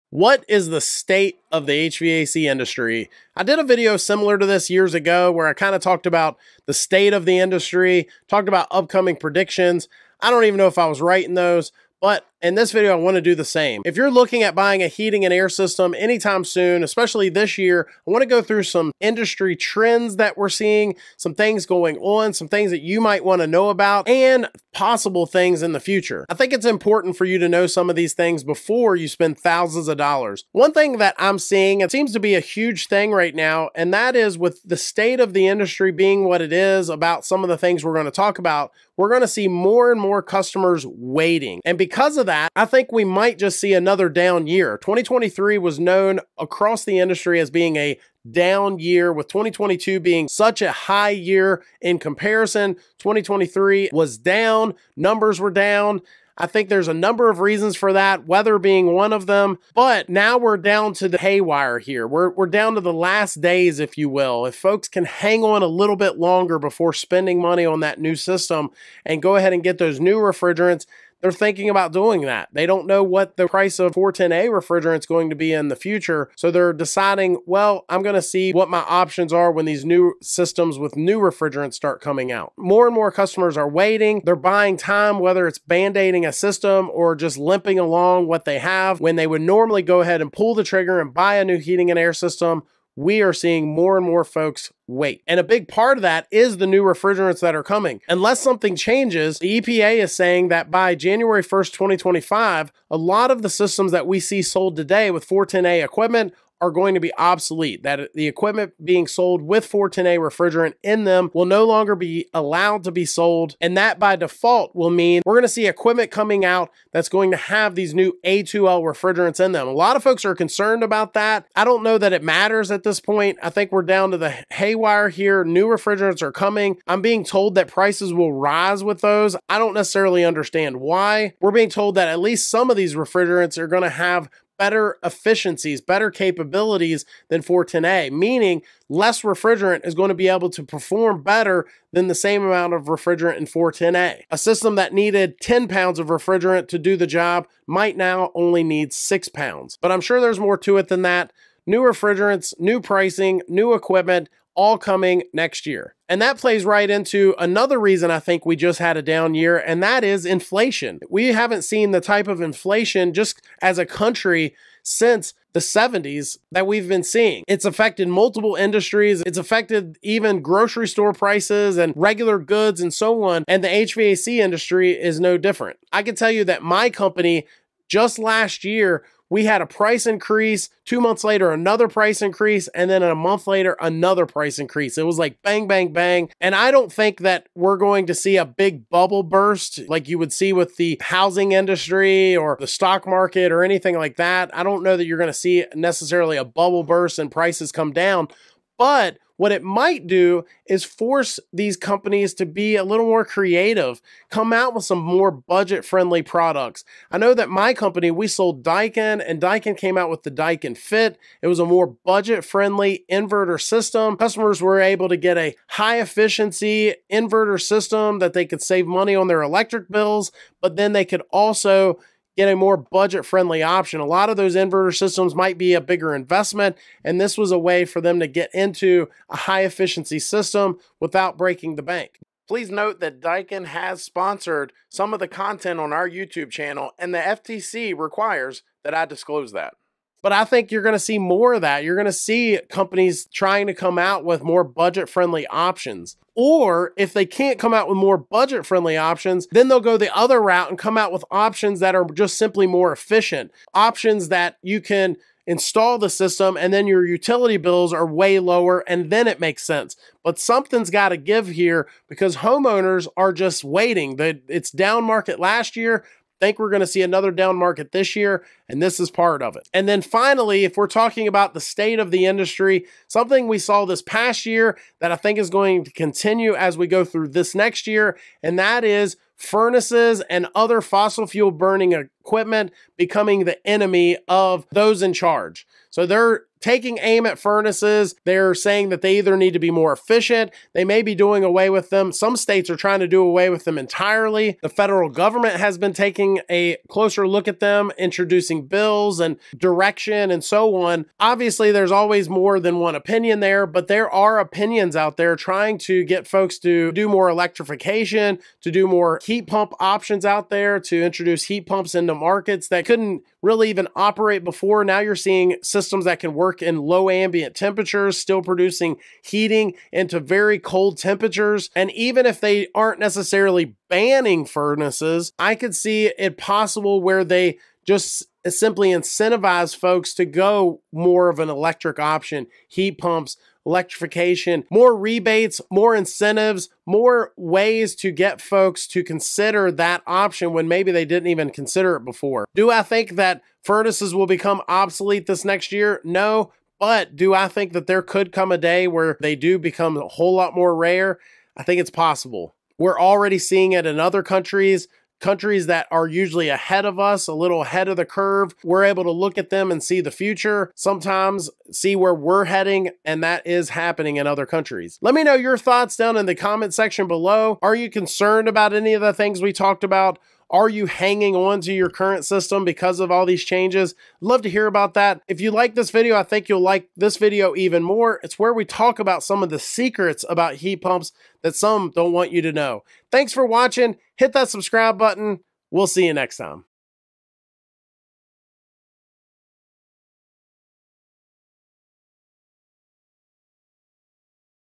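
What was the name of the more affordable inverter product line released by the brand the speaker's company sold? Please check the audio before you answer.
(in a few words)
Daikin Fit.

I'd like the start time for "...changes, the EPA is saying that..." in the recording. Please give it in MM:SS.
01:38.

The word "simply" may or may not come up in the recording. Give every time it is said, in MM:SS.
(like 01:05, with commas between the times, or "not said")
04:12, 05:28.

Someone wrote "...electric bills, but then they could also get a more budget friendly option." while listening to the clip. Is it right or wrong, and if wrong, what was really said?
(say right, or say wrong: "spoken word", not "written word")
right.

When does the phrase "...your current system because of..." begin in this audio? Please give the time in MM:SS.
06:11.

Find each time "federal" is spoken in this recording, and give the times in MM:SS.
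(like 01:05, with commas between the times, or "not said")
04:54.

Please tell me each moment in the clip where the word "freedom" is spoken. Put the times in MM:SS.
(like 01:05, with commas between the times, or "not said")
not said.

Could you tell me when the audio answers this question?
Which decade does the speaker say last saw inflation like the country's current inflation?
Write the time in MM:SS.
02:45.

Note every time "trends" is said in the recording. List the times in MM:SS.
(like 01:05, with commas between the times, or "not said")
00:19.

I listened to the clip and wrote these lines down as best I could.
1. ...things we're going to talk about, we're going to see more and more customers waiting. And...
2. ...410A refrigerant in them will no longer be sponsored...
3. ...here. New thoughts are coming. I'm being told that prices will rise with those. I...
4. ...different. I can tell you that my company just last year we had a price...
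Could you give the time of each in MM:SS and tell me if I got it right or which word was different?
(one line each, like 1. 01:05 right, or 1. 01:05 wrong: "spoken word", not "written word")
1. 00:37 right
2. 01:49 wrong: "allowed", not "sponsored"
3. 02:05 wrong: "refrigerants", not "thoughts"
4. 02:55 right.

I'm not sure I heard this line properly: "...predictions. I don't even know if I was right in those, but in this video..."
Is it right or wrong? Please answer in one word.
right.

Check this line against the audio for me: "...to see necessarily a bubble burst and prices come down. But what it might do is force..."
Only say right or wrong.
right.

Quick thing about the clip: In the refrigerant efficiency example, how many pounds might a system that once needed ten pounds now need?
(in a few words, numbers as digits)
6.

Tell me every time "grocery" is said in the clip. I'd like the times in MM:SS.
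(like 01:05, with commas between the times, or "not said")
02:50.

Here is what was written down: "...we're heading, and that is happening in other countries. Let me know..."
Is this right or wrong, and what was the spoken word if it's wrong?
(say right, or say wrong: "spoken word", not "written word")
right.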